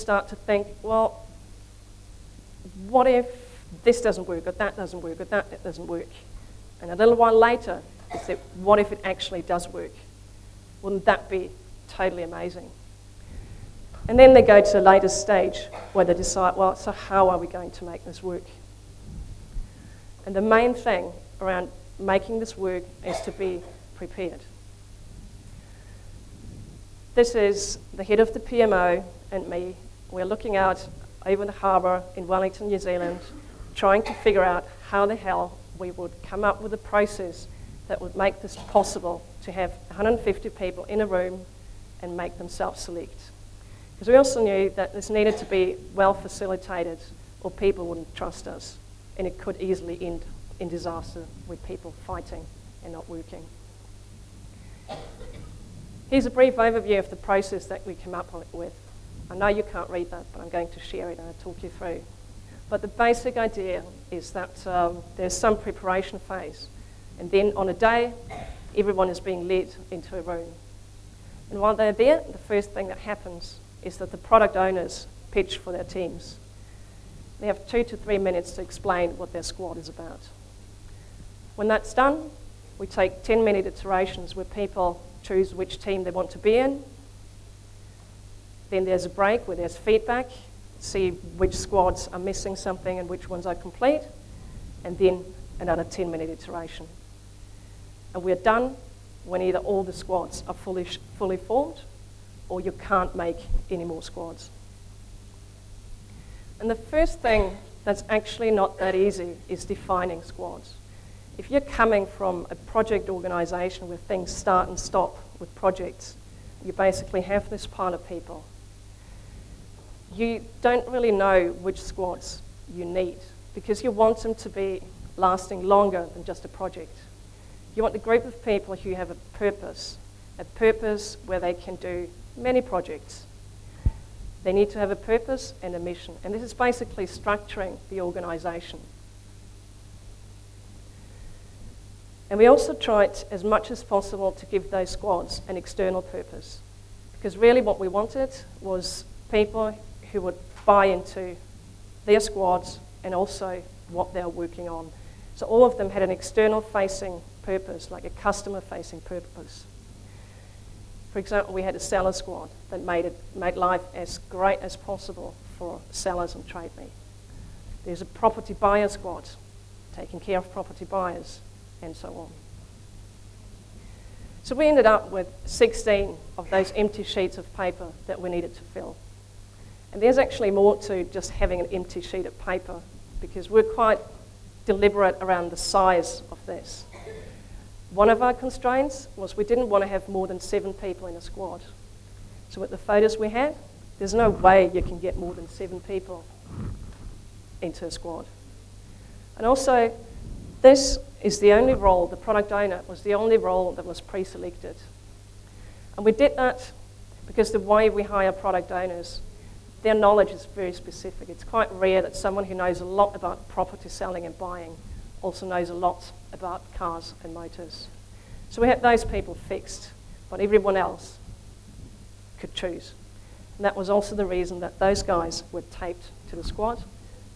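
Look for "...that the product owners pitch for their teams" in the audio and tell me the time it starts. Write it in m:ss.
1:13.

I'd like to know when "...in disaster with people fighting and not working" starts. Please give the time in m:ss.
0:50.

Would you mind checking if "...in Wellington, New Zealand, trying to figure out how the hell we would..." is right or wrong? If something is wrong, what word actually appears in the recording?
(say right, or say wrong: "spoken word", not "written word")
right.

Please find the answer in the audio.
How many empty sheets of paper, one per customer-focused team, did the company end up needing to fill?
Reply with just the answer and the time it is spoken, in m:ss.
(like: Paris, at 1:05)
16, at 2:55.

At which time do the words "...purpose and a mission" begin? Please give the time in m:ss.
2:14.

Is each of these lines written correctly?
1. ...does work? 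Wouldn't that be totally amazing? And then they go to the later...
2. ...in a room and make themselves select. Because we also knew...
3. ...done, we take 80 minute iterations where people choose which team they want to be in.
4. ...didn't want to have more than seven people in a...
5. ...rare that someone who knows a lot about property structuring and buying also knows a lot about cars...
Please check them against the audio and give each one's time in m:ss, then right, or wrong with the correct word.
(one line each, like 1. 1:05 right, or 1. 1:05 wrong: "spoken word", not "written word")
1. 0:09 right
2. 0:40 right
3. 1:21 wrong: "10", not "80"
4. 3:09 right
5. 3:31 wrong: "selling", not "structuring".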